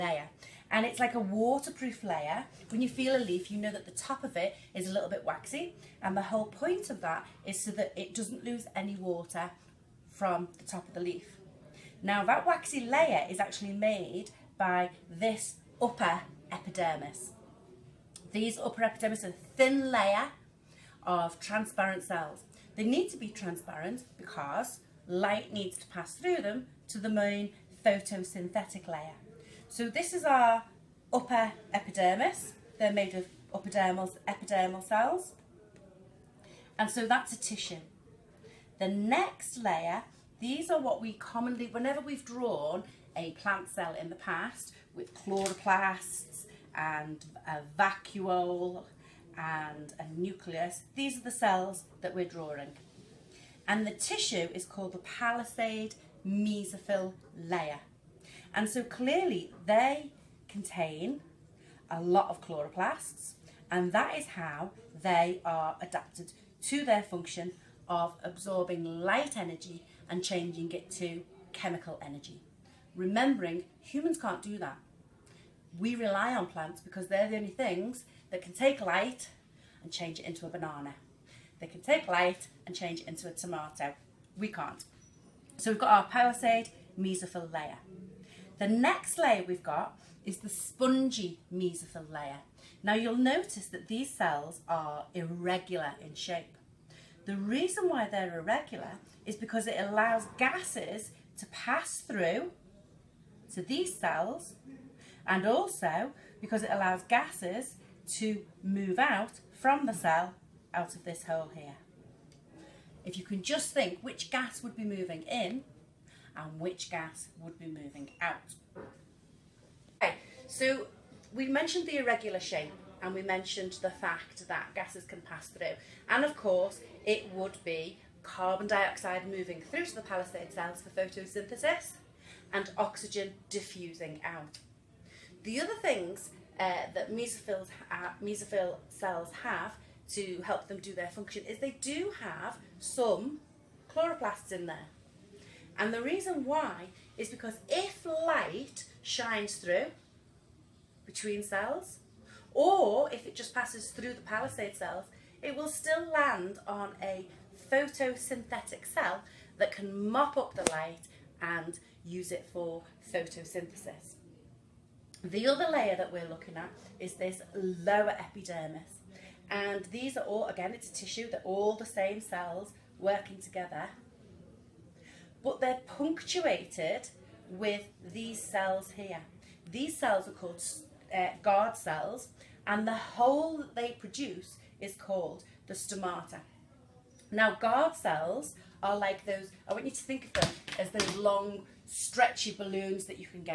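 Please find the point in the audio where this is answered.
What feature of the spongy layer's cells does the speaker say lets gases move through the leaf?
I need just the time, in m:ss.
2:01.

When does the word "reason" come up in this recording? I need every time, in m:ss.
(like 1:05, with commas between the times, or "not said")
1:37, 2:26.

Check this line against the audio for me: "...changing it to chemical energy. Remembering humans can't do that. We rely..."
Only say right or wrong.
right.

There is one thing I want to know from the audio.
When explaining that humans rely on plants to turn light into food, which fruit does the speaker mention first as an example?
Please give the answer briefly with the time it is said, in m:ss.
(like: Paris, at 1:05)
Banana, at 1:20.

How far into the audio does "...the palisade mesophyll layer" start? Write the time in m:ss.
0:54.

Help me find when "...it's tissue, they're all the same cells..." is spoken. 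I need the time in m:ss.
2:50.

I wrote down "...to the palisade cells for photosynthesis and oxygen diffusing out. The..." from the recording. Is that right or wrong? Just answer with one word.
right.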